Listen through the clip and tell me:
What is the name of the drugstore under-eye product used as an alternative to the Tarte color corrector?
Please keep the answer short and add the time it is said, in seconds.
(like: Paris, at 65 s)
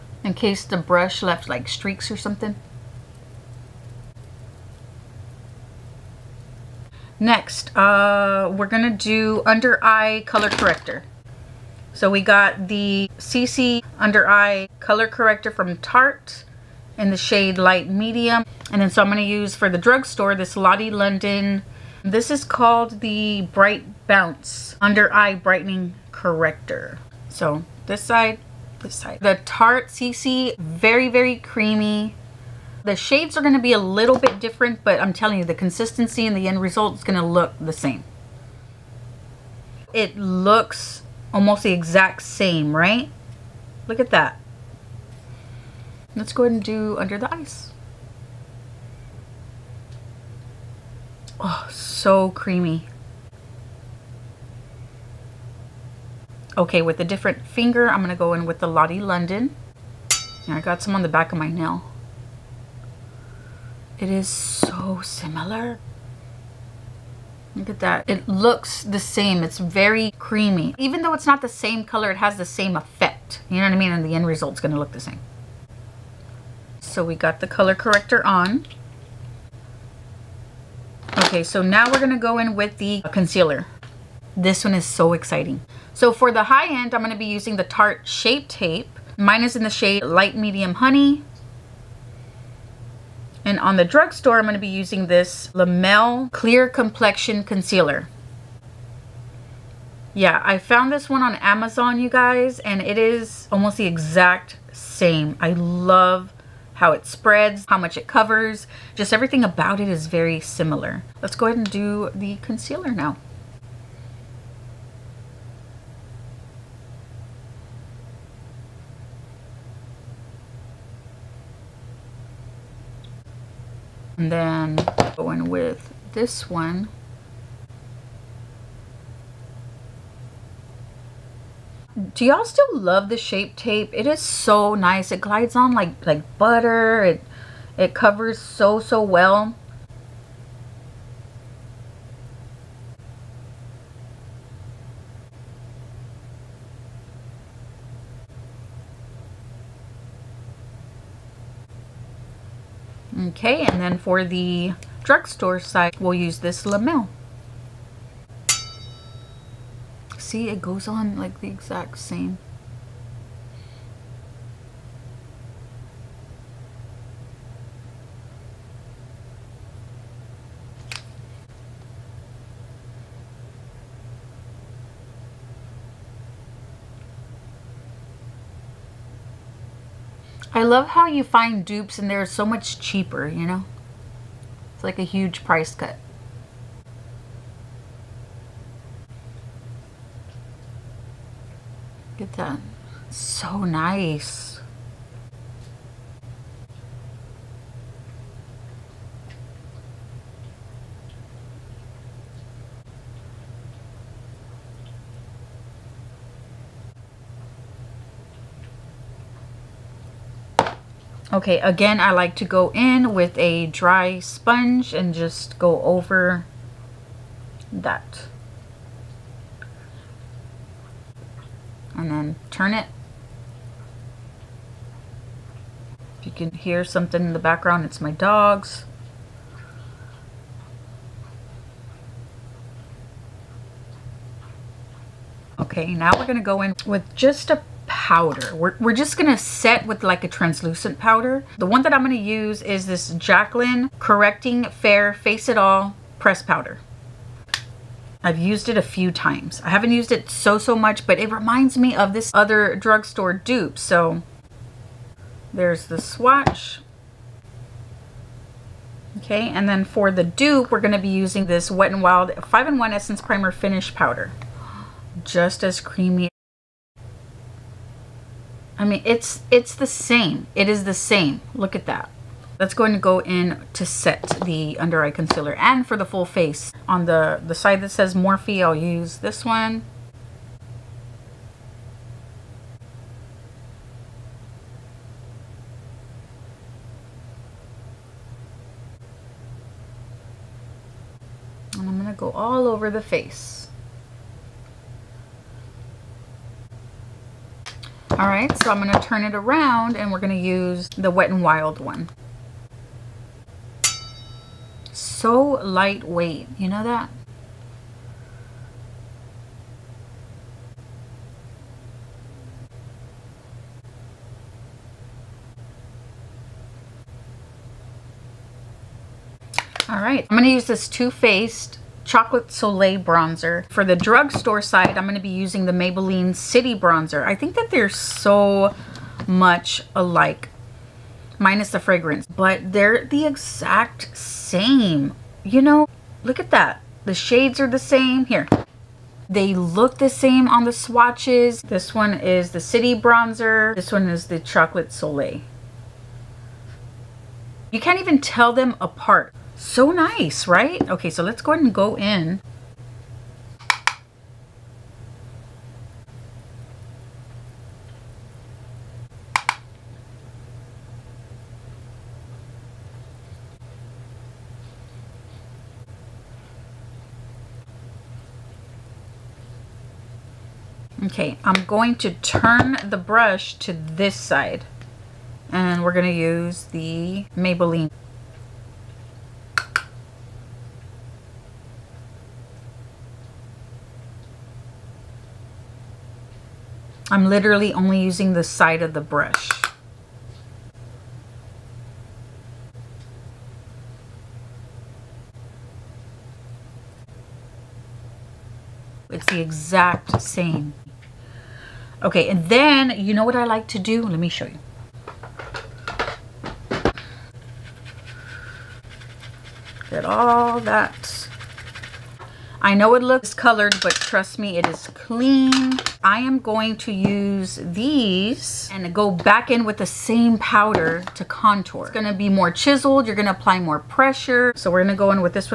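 Bright Bounce Under Eye Brightening Corrector, at 23 s.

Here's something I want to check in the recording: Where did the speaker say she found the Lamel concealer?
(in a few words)
Amazon.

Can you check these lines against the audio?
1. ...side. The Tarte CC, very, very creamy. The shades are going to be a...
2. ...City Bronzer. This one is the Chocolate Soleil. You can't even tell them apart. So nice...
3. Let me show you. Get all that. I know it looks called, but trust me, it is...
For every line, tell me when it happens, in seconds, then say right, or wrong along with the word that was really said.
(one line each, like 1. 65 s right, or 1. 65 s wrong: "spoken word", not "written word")
1. 28 s right
2. 342 s right
3. 404 s wrong: "colored", not "called".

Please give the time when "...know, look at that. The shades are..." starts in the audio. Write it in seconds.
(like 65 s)
335 s.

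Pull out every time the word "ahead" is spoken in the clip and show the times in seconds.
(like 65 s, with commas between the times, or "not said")
46 s, 111 s, 351 s.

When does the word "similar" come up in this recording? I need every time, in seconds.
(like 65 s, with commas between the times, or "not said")
65 s, 110 s.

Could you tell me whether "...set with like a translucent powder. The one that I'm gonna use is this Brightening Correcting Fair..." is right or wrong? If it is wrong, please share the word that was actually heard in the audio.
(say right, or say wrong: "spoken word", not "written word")
wrong: "Jacqueline", not "Brightening".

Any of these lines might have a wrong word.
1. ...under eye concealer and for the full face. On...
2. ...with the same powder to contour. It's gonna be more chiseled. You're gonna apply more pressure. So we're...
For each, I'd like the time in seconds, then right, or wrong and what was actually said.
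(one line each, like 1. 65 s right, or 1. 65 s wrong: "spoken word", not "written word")
1. 274 s right
2. 419 s right.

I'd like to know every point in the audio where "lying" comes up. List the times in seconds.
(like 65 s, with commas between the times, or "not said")
not said.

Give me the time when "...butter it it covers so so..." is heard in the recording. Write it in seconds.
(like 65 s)
136 s.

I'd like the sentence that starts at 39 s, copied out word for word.
It looks almost the exact same, right?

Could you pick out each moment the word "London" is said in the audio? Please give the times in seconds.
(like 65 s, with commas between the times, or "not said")
20 s, 58 s.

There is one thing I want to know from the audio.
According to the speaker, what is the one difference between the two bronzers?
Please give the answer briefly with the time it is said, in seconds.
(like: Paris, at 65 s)
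the fragrance, at 331 s.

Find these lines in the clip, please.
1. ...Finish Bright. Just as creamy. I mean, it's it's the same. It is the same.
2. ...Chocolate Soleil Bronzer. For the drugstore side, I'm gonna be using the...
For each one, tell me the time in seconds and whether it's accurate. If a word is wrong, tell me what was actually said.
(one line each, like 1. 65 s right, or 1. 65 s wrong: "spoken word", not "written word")
1. 263 s wrong: "Powder", not "Bright"
2. 322 s right.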